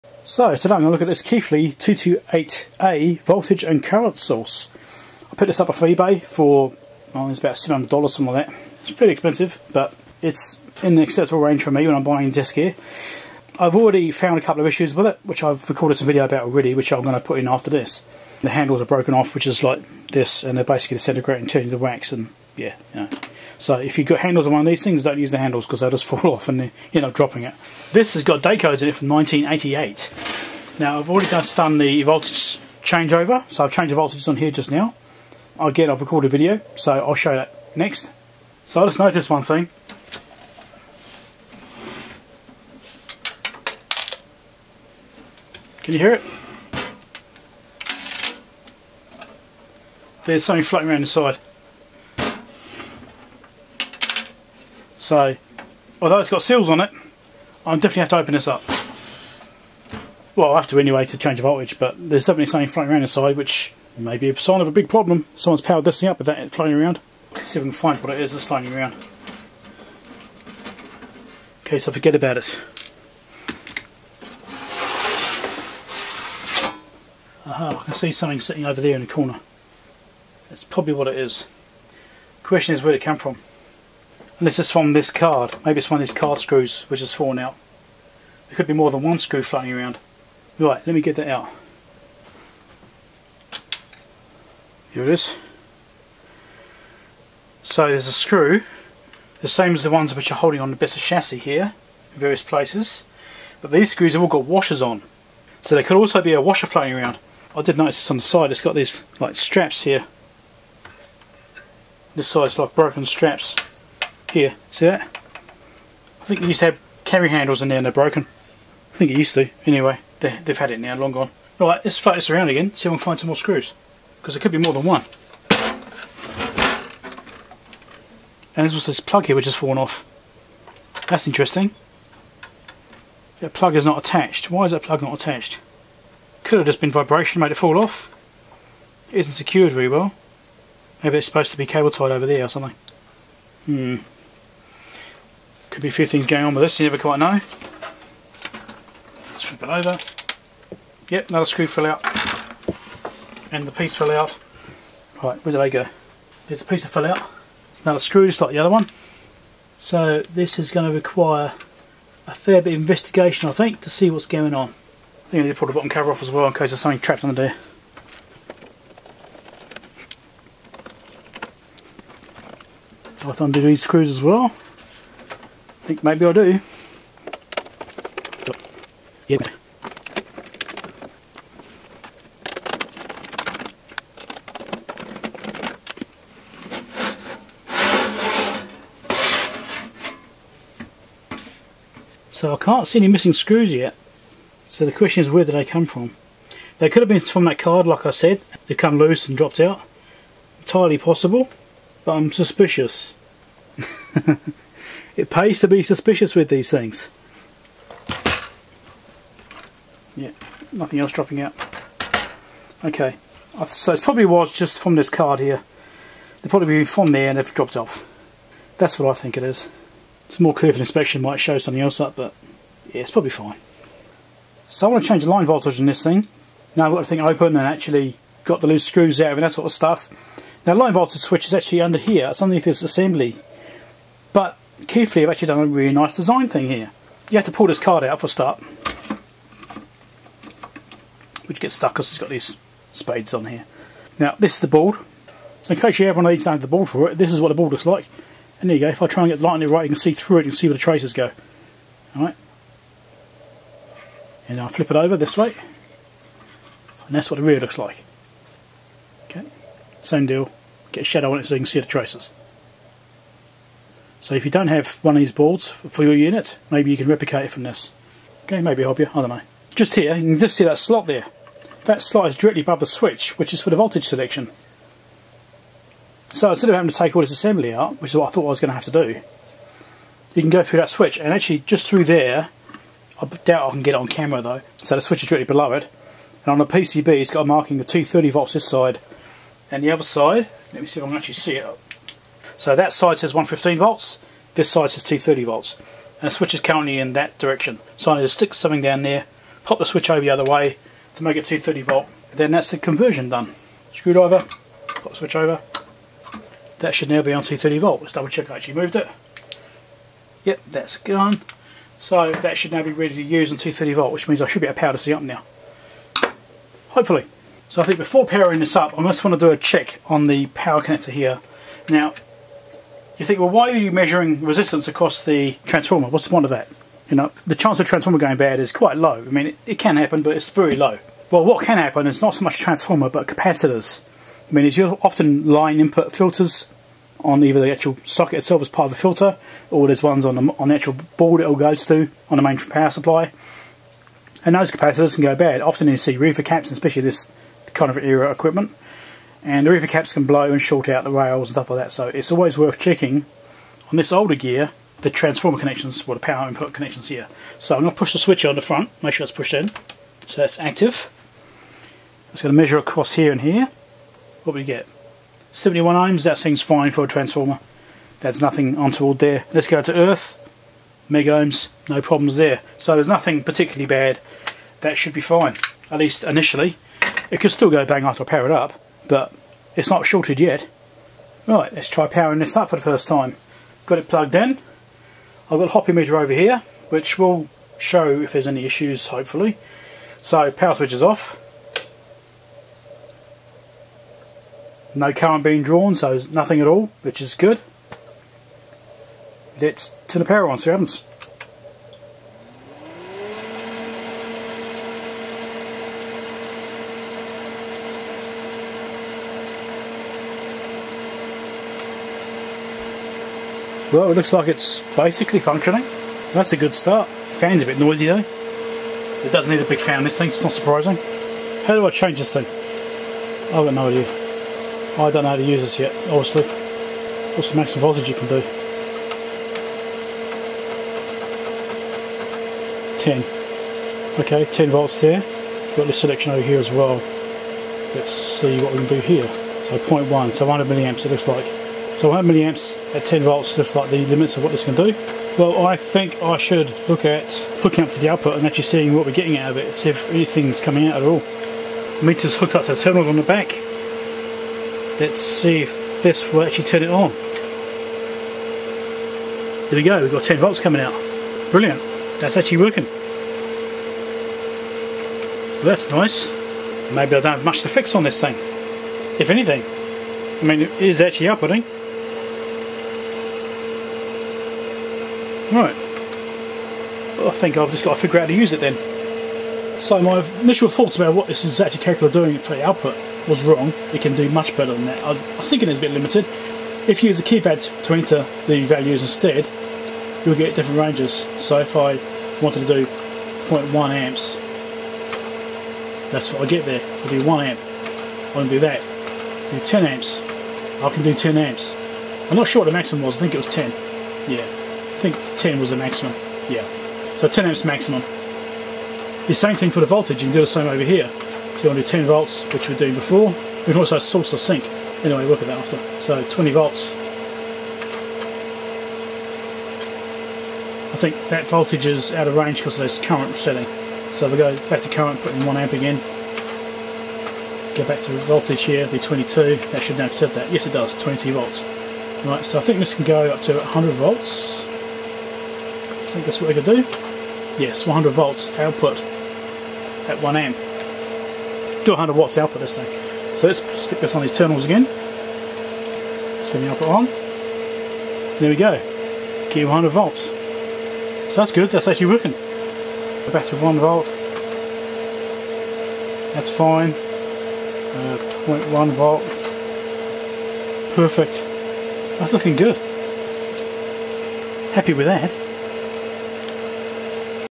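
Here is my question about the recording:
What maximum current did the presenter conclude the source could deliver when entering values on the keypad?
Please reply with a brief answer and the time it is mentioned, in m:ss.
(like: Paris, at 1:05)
10 amps, at 8:27.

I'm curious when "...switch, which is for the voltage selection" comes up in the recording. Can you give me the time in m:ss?
4:32.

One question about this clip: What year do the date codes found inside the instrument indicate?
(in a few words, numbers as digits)
1988.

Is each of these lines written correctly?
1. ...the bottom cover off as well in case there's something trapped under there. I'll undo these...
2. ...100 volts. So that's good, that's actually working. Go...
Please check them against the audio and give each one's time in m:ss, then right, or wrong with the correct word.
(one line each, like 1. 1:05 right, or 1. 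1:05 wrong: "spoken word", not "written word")
1. 2:45 right
2. 9:09 right.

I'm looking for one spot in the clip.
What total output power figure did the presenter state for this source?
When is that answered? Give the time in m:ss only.
9:01.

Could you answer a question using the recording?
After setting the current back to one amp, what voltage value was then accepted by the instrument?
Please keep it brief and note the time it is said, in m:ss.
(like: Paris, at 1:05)
22 volts, at 8:50.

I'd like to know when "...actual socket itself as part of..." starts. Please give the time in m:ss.
5:37.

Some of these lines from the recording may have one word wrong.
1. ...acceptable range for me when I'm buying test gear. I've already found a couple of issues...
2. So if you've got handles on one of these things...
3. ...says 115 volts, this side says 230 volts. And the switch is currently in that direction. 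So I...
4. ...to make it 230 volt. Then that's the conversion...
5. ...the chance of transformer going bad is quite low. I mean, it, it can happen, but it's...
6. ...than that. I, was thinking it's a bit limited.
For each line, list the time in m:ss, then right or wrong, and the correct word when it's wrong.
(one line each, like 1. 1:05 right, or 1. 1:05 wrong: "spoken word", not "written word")
1. 0:11 right
2. 0:23 right
3. 4:53 right
4. 5:01 right
5. 5:27 right
6. 8:04 right.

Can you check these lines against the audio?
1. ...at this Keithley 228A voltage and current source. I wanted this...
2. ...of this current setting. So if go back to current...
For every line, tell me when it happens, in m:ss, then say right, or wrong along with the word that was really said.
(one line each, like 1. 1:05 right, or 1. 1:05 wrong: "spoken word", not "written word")
1. 0:01 wrong: "picked", not "wanted"
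2. 8:42 right.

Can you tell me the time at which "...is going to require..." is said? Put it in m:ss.
2:40.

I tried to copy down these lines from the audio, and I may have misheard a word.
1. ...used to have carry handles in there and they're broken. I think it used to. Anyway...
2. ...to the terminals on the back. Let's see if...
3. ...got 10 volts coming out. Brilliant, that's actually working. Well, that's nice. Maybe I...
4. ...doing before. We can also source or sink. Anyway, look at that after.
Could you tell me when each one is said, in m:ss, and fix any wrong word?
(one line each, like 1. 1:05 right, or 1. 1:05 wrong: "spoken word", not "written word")
1. 1:56 right
2. 7:32 right
3. 7:40 right
4. 8:32 right.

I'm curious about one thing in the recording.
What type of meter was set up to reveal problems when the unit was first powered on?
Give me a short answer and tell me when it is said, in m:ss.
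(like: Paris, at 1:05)
hoppy meter, at 6:25.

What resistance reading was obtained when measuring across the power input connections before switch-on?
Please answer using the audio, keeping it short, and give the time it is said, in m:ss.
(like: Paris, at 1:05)
71 ohms, at 6:05.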